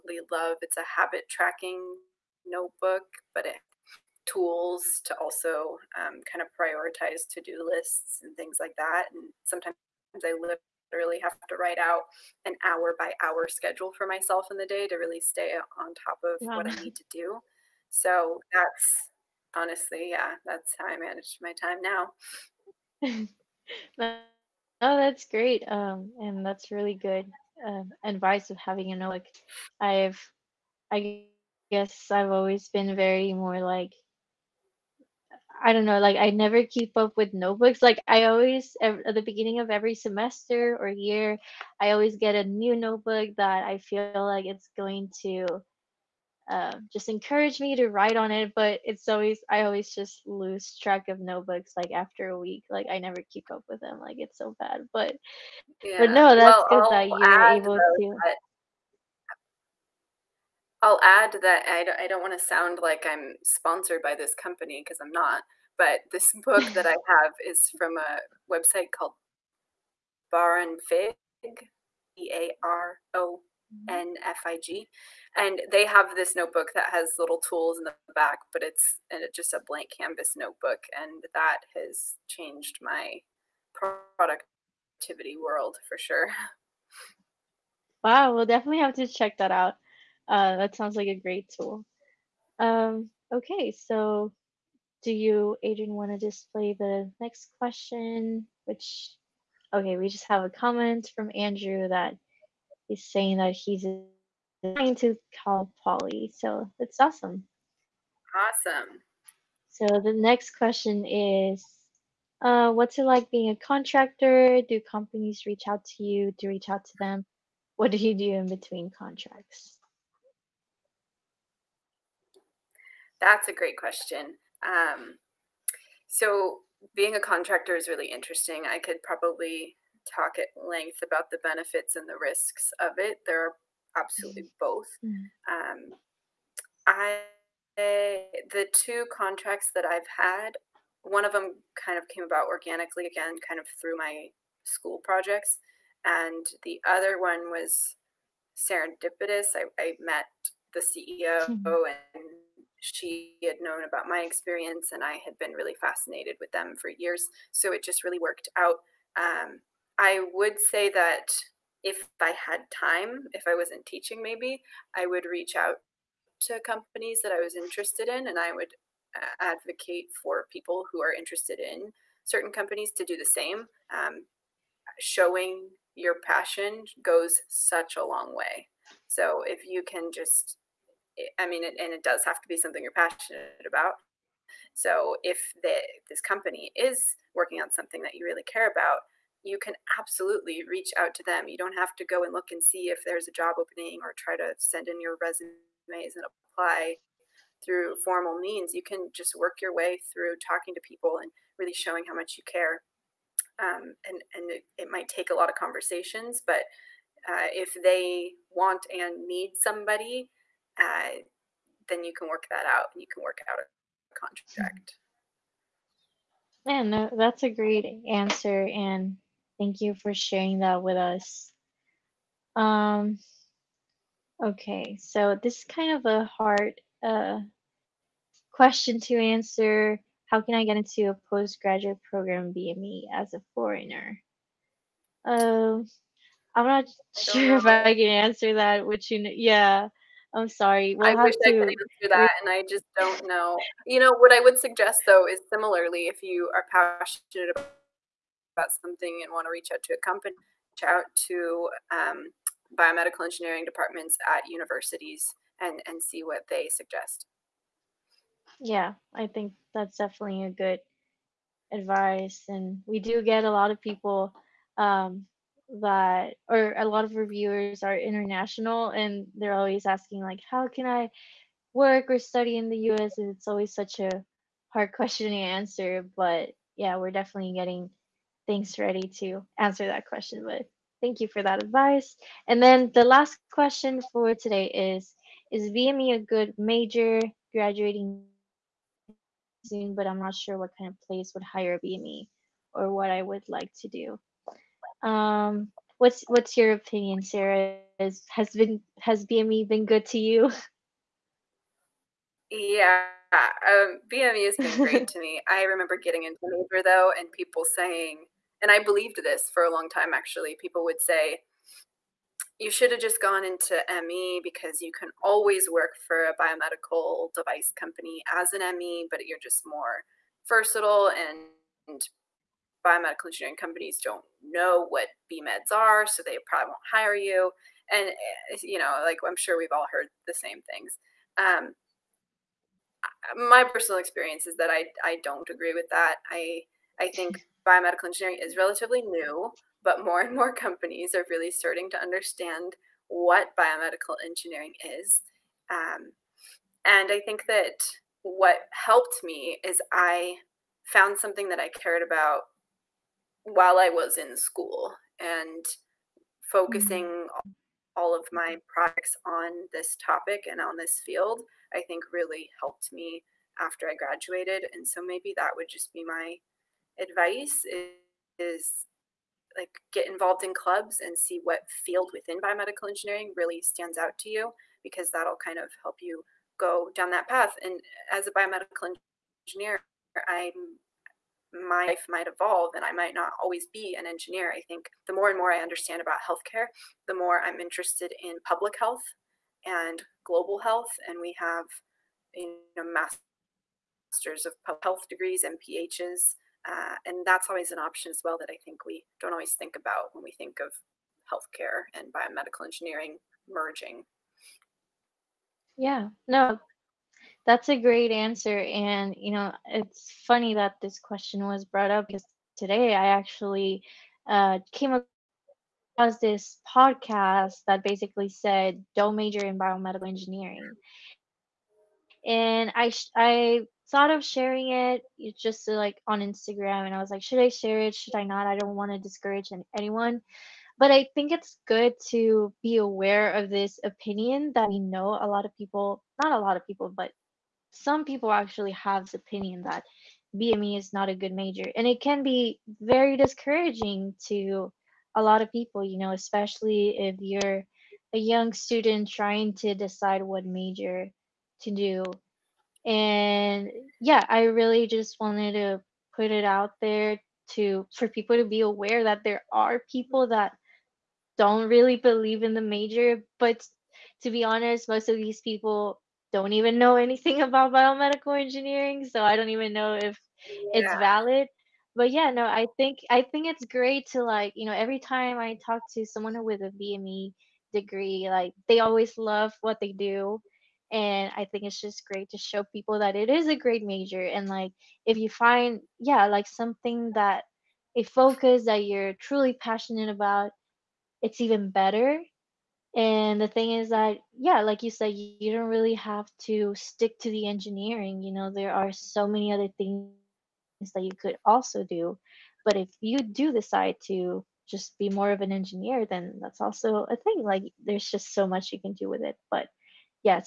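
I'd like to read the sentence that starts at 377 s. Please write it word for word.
And as a biomedical engineer, I'm my life might evolve and I might not always be an engineer.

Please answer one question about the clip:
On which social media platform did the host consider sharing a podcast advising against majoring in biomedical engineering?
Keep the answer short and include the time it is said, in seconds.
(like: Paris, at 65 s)
Instagram, at 426 s.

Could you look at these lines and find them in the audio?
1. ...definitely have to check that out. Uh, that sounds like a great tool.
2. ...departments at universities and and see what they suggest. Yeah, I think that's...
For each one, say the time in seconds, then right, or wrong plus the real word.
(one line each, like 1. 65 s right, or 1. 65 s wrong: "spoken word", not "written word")
1. 88 s right
2. 253 s right.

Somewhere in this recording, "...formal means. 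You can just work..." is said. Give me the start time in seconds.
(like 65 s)
198 s.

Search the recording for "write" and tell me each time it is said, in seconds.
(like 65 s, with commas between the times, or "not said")
11 s, 47 s.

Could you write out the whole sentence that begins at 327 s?
And, eh, you know, like I'm sure we've all heard the same things.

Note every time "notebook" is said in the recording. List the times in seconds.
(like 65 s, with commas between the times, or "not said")
2 s, 37 s, 42 s, 51 s, 76 s, 80 s.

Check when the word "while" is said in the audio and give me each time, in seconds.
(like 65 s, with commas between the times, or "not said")
353 s.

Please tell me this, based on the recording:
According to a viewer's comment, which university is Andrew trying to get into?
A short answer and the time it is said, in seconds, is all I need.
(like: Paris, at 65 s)
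Cal Poly, at 105 s.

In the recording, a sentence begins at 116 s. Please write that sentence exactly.
Do you reach out to them?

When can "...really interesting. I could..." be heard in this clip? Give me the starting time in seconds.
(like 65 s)
127 s.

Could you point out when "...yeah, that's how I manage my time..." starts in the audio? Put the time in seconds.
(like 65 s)
20 s.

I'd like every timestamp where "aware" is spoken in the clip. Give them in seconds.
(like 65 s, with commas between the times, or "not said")
432 s, 458 s.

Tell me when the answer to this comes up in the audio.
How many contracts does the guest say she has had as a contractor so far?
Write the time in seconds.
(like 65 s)
138 s.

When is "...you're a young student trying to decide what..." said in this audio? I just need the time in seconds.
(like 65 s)
447 s.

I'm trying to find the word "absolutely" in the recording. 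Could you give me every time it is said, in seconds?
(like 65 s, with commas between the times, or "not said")
133 s, 189 s.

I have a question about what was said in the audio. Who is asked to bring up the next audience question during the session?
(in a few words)
Adrian.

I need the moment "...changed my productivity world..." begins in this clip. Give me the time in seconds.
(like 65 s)
82 s.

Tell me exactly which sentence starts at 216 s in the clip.
And that's a great answer, and thank you for sharing that with us.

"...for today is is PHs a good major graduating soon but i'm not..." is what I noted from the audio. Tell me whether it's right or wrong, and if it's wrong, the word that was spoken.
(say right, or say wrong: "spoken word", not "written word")
wrong: "BME", not "PHs".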